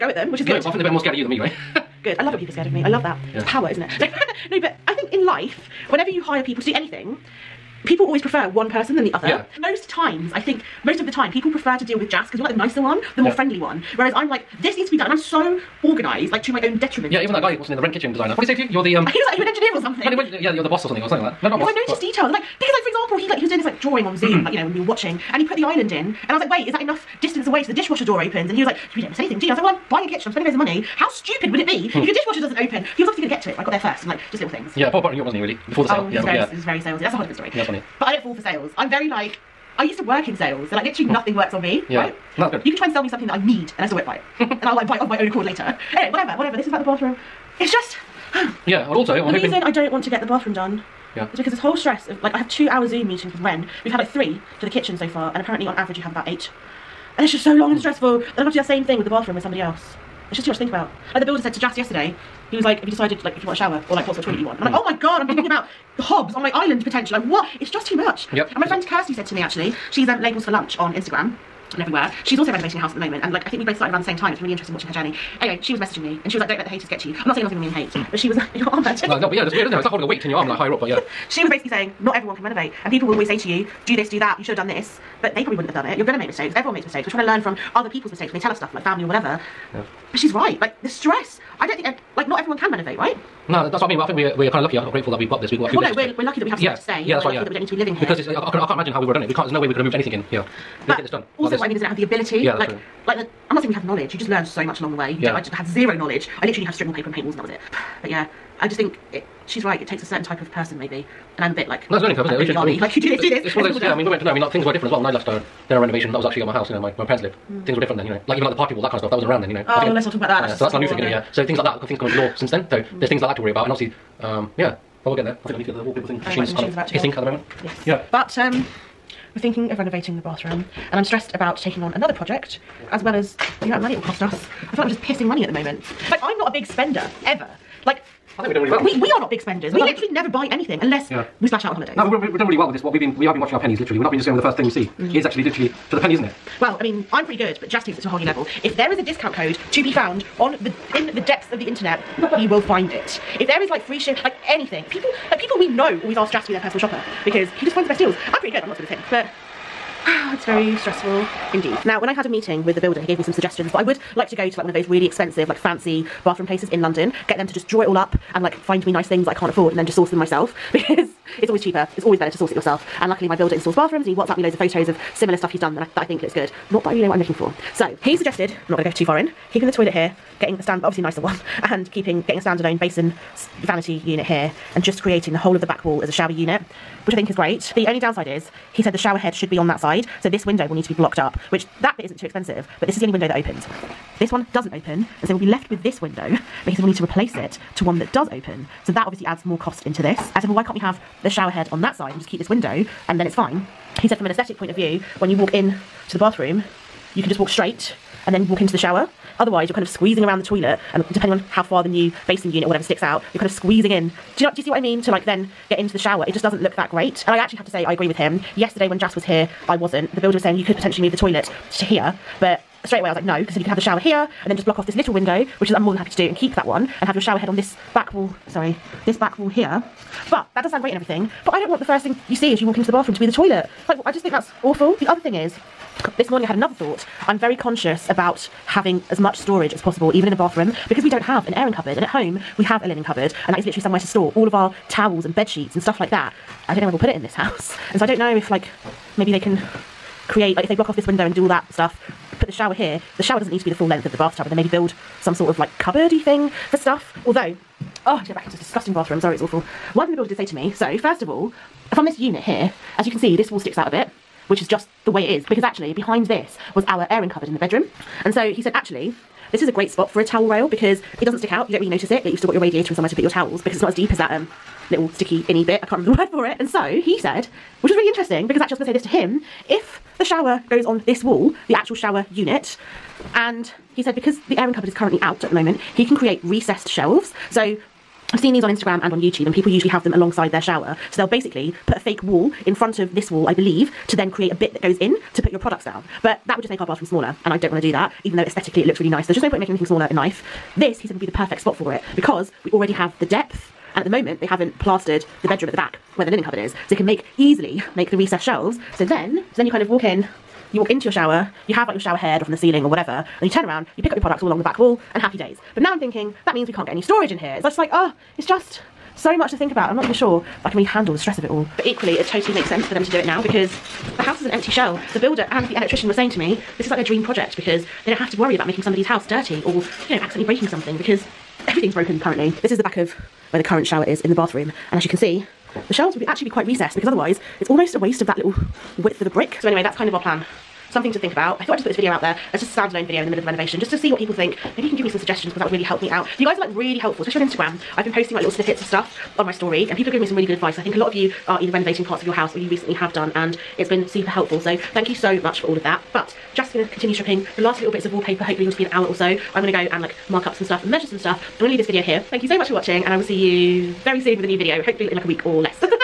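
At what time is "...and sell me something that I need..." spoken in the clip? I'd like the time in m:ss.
0:42.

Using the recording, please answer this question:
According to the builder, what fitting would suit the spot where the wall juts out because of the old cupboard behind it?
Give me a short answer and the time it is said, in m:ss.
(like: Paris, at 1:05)
towel rail, at 4:30.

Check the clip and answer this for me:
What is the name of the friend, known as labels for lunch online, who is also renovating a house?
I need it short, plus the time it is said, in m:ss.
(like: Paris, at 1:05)
Kirsty, at 1:08.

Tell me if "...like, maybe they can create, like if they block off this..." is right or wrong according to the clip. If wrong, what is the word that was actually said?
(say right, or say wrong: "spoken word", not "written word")
right.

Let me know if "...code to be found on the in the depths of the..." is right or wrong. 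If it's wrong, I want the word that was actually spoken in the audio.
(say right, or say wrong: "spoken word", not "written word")
right.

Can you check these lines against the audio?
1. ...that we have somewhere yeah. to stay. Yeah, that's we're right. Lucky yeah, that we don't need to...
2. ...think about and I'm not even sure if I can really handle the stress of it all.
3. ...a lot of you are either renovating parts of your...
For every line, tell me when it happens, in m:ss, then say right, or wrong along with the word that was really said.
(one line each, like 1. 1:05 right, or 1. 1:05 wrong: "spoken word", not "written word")
1. 1:36 right
2. 5:19 right
3. 5:50 right.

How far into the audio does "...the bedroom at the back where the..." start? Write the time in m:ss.
5:05.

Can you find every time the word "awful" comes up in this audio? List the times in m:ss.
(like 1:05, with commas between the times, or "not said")
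3:54, 4:19.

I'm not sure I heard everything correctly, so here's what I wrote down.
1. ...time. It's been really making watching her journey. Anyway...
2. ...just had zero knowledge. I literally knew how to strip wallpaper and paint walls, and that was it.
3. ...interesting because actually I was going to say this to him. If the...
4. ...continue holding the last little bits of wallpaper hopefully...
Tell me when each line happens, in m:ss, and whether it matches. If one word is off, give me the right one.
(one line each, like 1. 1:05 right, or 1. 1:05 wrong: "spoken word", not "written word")
1. 1:14 wrong: "interesting", not "making"
2. 1:45 right
3. 4:38 right
4. 5:56 wrong: "stripping", not "holding".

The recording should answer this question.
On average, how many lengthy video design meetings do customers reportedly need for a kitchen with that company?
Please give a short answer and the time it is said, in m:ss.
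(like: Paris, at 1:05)
8, at 0:56.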